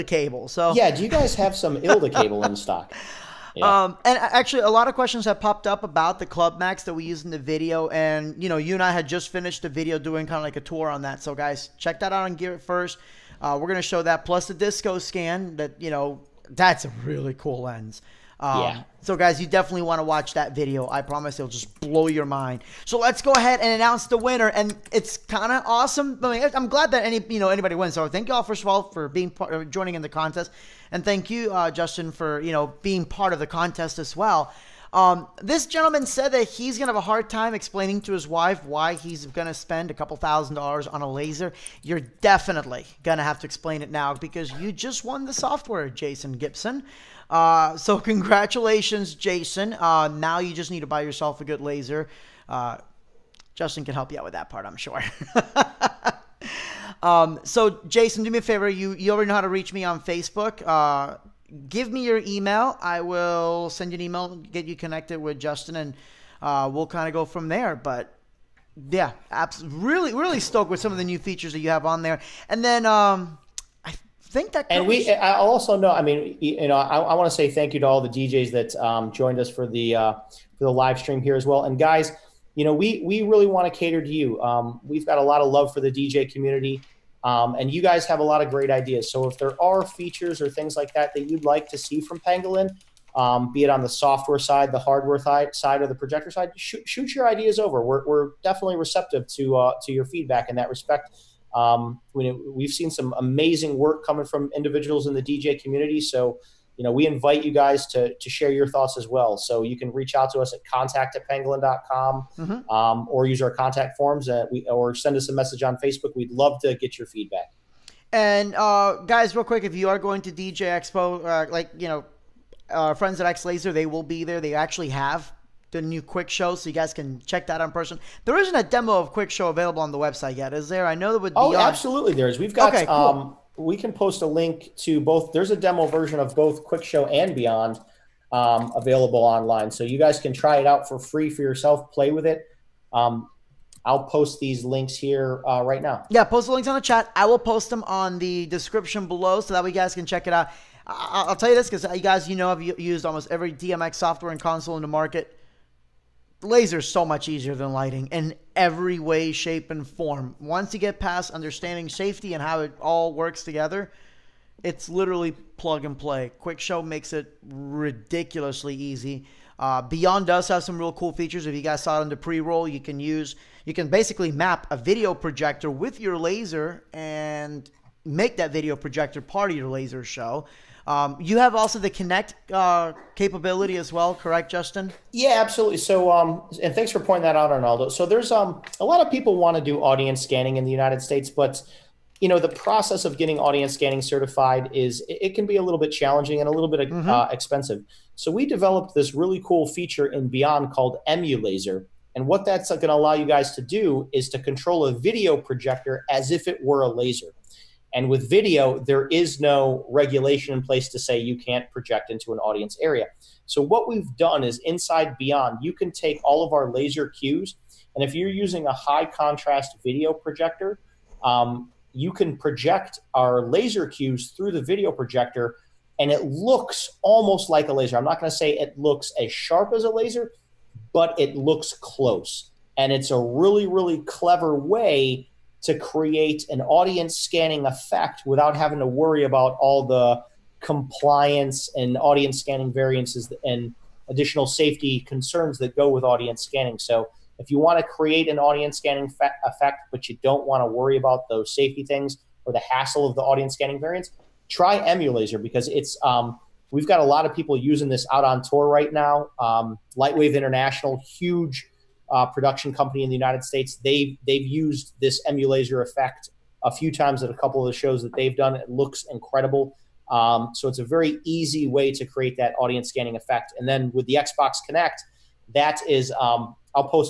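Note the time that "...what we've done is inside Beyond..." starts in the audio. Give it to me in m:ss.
3:33.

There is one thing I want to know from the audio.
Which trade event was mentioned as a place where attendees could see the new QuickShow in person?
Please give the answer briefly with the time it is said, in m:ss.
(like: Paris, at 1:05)
DJ Expo, at 2:00.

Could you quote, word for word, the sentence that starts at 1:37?
We're, we're definitely receptive to uh, to your feedback in that respect.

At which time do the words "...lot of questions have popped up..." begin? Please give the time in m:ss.
0:04.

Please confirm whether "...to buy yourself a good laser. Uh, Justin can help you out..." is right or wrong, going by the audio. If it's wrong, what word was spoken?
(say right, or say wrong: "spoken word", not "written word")
right.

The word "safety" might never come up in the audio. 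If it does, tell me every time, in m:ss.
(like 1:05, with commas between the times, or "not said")
2:41, 4:04, 4:11.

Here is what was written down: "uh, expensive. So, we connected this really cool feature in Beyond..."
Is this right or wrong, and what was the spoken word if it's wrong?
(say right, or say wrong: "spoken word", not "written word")
wrong: "developed", not "connected".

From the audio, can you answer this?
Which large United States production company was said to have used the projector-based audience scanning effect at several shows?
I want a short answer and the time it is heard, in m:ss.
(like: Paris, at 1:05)
Lightwave International, at 4:19.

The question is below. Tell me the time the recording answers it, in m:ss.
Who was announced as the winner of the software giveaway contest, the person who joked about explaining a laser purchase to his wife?
0:45.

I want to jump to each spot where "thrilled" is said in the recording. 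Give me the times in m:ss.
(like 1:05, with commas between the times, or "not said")
not said.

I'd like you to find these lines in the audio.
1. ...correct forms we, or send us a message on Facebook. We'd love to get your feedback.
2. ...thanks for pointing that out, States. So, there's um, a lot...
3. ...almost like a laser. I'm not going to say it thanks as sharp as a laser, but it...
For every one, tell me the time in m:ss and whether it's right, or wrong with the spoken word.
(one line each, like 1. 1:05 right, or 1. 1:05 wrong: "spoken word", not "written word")
1. 1:53 wrong: "contact", not "correct"
2. 3:06 wrong: "Arnaldo", not "States"
3. 3:47 wrong: "looks", not "thanks".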